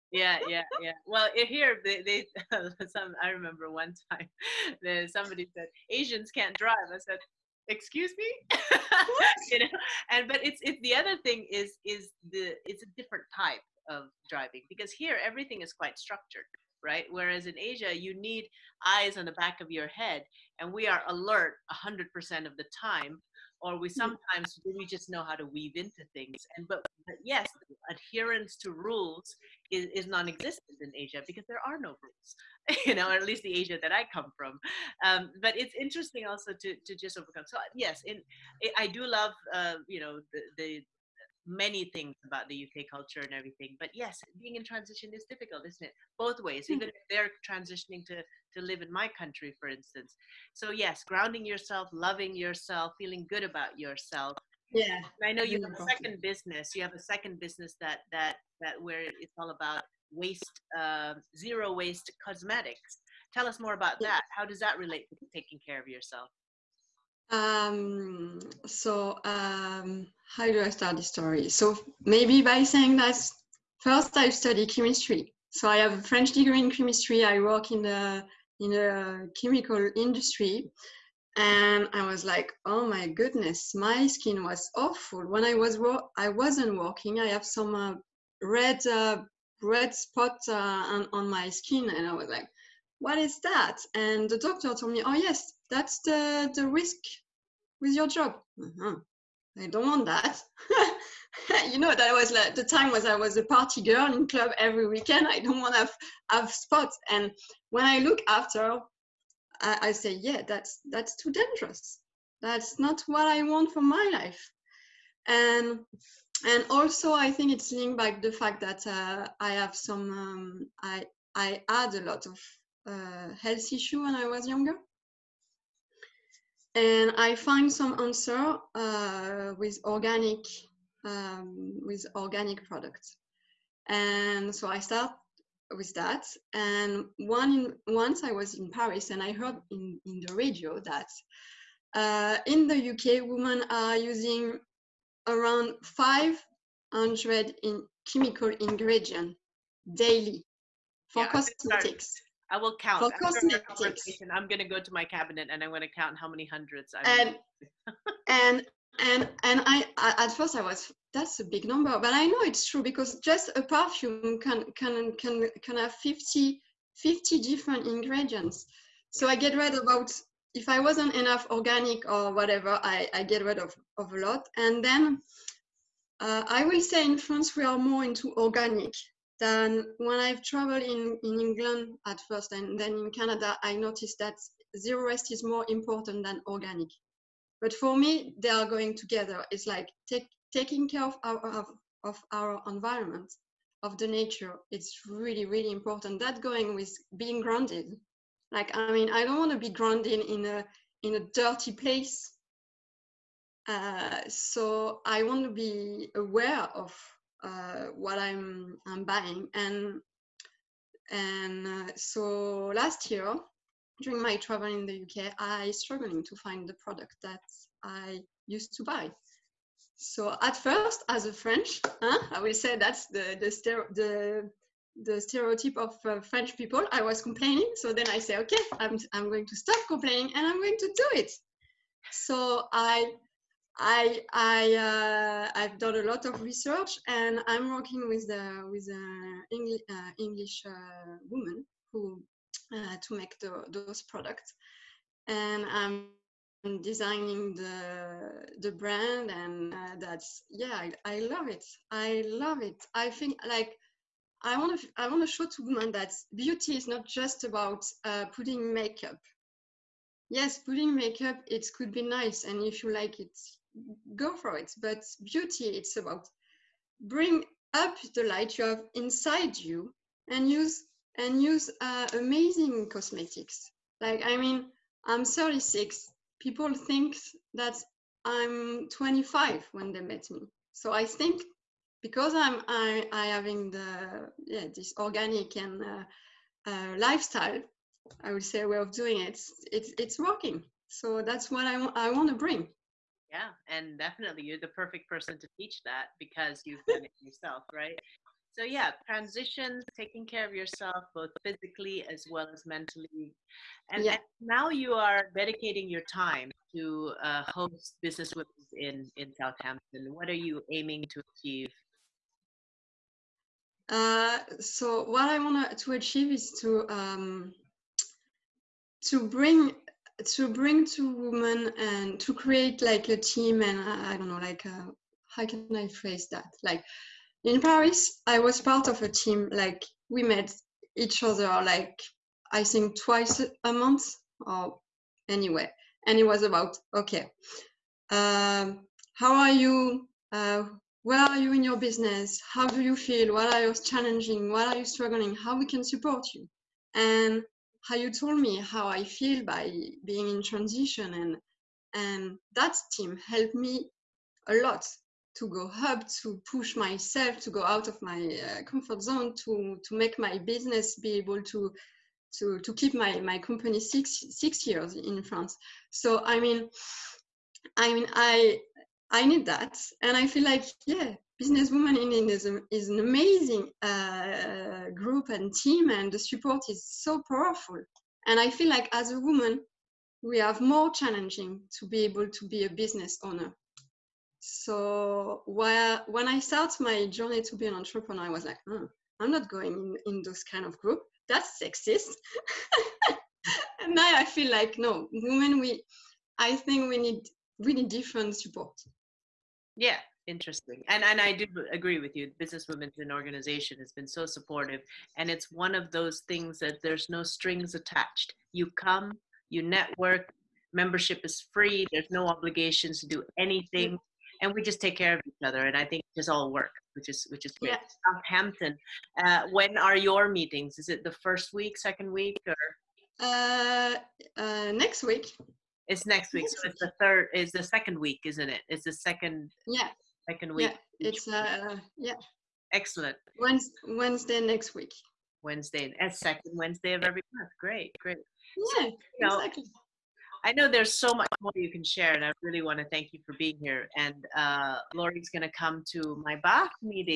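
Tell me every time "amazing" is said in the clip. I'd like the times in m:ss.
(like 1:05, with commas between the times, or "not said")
4:32, 6:12.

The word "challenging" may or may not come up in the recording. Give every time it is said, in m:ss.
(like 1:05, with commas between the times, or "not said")
5:43, 6:20.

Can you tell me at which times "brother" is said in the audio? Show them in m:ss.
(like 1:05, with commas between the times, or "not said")
not said.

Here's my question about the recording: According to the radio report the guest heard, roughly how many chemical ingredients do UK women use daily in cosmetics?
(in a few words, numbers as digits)
500.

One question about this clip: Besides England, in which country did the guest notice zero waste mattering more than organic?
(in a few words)
Canada.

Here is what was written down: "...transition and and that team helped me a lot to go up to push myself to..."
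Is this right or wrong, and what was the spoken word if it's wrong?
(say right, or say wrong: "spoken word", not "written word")
right.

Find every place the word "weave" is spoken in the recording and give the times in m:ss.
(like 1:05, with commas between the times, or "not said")
0:25.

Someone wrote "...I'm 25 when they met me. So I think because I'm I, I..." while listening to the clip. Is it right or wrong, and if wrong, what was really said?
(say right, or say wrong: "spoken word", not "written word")
right.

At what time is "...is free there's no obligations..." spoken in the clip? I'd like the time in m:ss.
6:51.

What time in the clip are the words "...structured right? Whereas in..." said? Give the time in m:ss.
0:15.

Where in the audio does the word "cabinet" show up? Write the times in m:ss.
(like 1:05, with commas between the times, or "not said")
2:35.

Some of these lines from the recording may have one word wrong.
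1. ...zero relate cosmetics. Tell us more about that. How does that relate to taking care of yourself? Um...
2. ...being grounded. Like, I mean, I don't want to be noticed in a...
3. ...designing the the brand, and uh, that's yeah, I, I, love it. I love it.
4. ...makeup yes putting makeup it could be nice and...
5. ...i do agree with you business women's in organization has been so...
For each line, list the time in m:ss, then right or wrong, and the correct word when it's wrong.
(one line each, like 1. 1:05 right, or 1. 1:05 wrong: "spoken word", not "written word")
1. 1:01 wrong: "waste", not "relate"
2. 3:17 wrong: "grounded", not "noticed"
3. 4:06 right
4. 4:18 right
5. 6:41 right.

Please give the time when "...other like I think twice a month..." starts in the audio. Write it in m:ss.
5:31.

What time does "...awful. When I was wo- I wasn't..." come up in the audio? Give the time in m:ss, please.
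1:24.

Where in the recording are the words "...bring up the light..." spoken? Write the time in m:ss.
4:27.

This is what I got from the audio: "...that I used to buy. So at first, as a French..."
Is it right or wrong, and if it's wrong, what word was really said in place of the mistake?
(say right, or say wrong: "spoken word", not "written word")
right.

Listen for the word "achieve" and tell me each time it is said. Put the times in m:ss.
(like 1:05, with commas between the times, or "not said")
5:11, 5:15.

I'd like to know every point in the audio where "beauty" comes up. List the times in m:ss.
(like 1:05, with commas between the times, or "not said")
4:16, 4:25.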